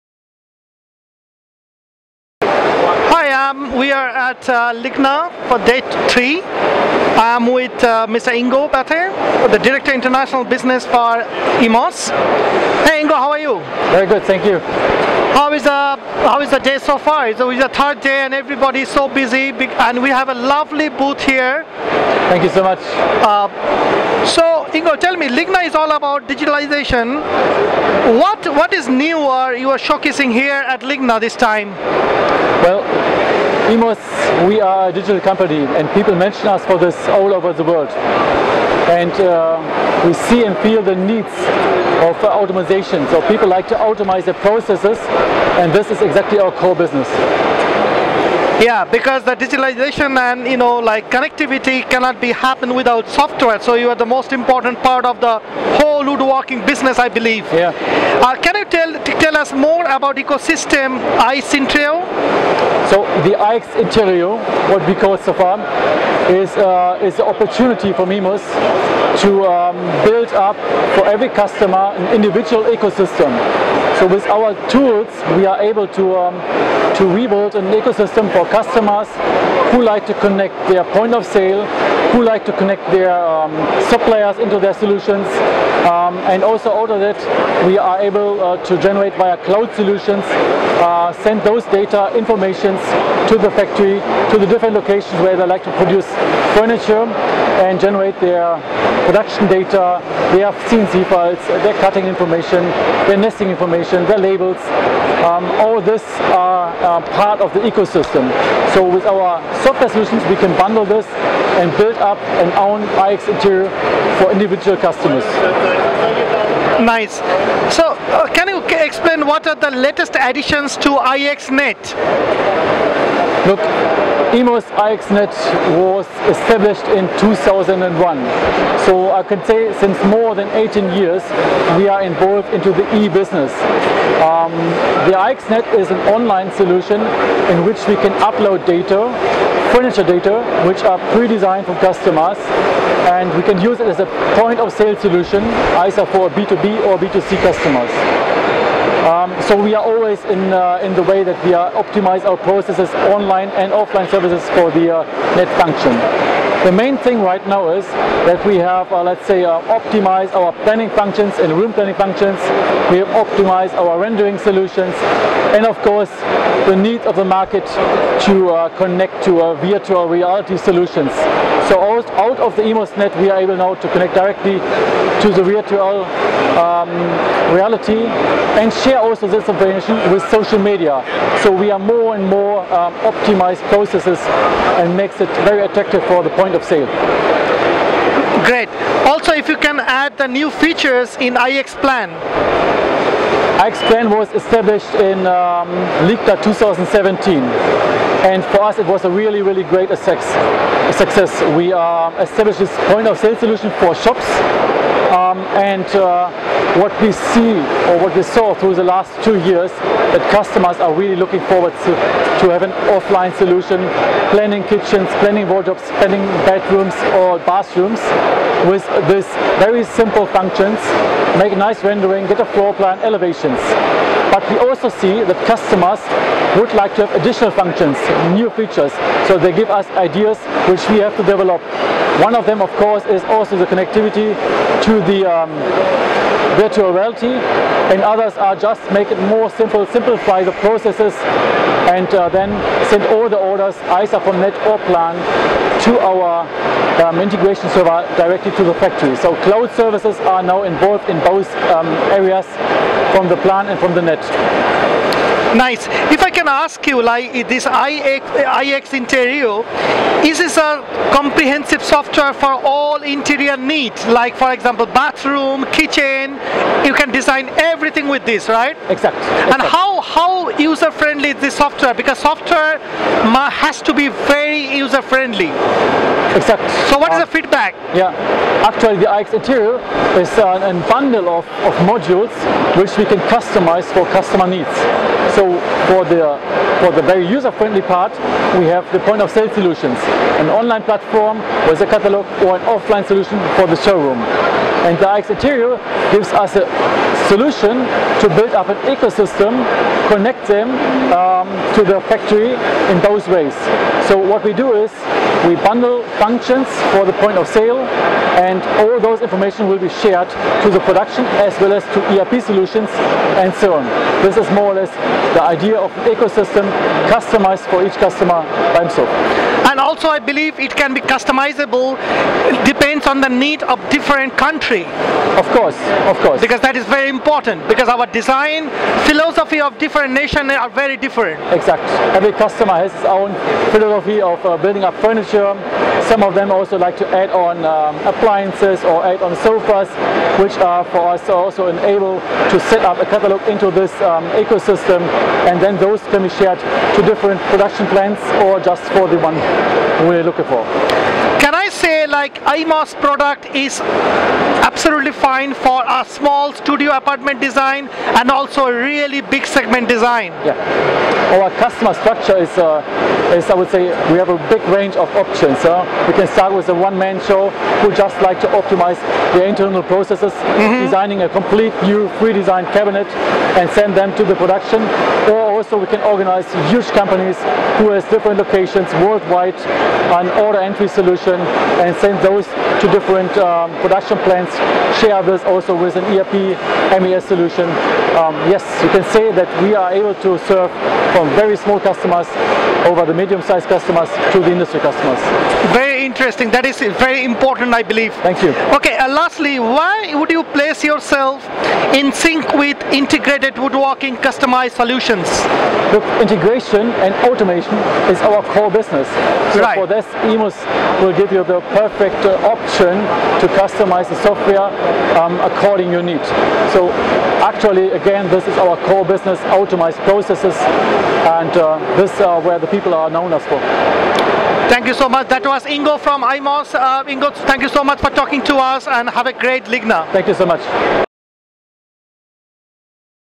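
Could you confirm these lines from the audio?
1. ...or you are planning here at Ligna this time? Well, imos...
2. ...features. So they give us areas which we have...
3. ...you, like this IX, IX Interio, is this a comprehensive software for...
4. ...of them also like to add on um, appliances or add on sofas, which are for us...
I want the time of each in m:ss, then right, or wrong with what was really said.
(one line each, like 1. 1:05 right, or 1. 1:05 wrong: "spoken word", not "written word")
1. 0:29 wrong: "showcasing", not "planning"
2. 3:48 wrong: "ideas", not "areas"
3. 4:16 right
4. 5:36 right.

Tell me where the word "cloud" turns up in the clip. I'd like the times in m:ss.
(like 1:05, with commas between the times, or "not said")
1:29, 4:09.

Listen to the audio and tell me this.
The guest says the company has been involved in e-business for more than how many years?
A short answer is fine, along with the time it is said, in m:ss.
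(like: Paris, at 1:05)
18, at 2:10.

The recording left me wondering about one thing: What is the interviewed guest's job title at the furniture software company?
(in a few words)
Director International Business.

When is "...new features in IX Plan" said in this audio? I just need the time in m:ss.
3:10.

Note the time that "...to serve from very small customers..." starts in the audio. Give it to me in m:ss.
6:30.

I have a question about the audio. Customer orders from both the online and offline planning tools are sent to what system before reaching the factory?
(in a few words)
integration server.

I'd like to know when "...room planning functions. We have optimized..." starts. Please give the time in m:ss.
2:41.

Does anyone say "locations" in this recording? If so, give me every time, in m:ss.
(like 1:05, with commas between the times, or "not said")
1:34, 6:18.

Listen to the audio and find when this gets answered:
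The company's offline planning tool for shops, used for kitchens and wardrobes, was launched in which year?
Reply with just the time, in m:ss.
3:16.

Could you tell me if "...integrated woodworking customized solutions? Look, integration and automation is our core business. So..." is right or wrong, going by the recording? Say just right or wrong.
right.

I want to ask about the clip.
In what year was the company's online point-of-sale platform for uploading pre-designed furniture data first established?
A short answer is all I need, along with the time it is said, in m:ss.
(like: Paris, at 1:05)
2001, at 2:07.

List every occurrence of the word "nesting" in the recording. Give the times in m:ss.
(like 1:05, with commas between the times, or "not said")
1:43.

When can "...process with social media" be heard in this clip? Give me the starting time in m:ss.
2:59.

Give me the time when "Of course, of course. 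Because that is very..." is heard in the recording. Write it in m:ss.
5:25.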